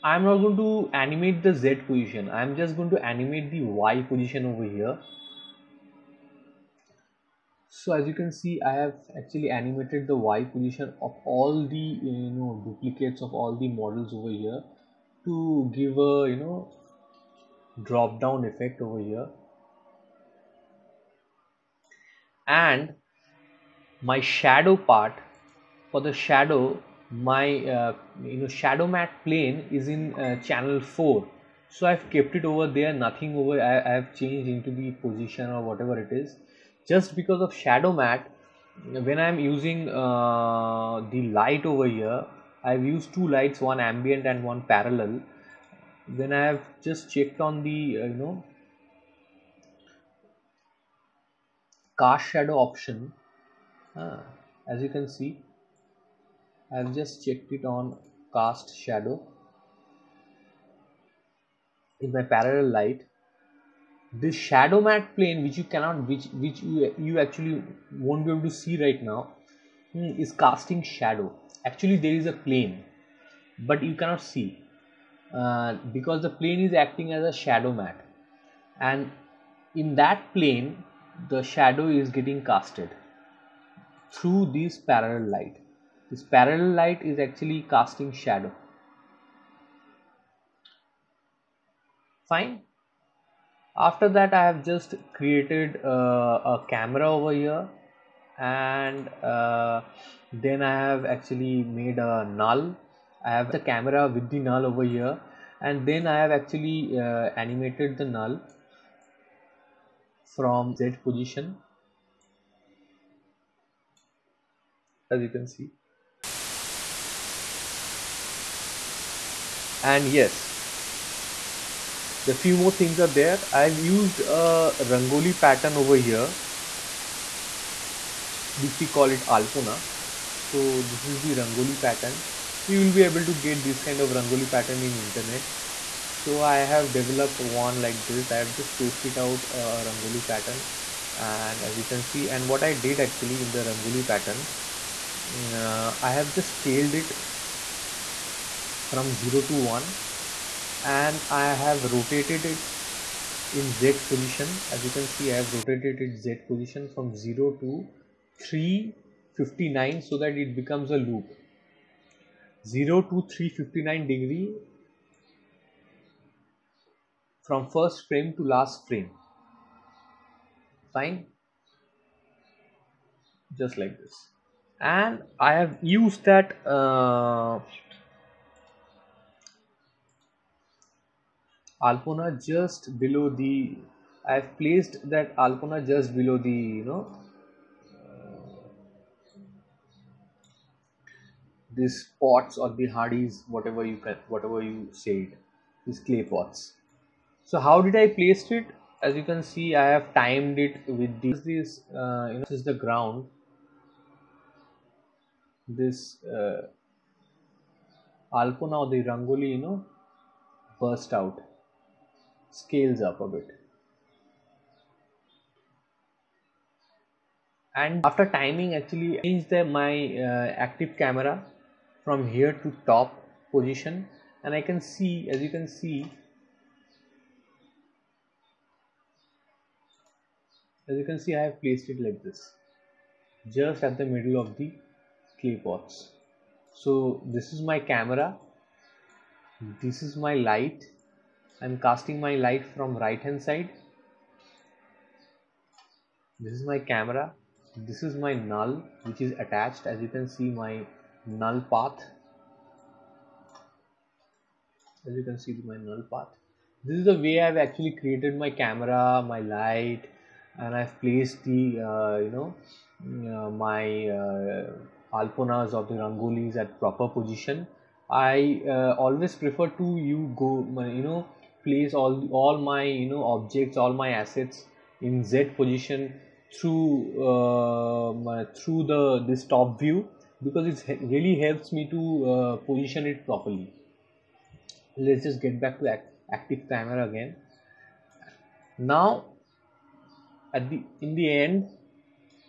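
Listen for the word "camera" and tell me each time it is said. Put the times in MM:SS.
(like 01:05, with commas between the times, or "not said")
01:36, 01:43, 03:40, 03:57, 04:06, 04:18, 04:46.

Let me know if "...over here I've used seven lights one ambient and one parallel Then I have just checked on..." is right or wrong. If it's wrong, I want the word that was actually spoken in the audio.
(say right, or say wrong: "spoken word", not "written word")
wrong: "two", not "seven".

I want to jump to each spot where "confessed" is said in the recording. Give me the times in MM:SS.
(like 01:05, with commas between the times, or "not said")
not said.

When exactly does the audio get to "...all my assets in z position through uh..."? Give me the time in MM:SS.
04:33.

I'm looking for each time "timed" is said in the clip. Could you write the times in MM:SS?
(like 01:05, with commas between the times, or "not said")
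03:20.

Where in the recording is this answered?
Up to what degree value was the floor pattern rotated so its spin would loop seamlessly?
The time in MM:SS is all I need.
02:42.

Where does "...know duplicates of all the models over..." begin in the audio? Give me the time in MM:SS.
00:12.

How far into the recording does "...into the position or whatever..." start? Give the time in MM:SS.
00:34.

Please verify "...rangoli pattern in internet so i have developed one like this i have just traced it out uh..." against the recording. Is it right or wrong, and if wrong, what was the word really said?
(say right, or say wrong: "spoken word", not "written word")
right.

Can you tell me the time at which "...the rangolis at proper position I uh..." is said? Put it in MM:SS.
04:25.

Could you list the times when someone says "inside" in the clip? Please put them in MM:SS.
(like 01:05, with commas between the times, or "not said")
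not said.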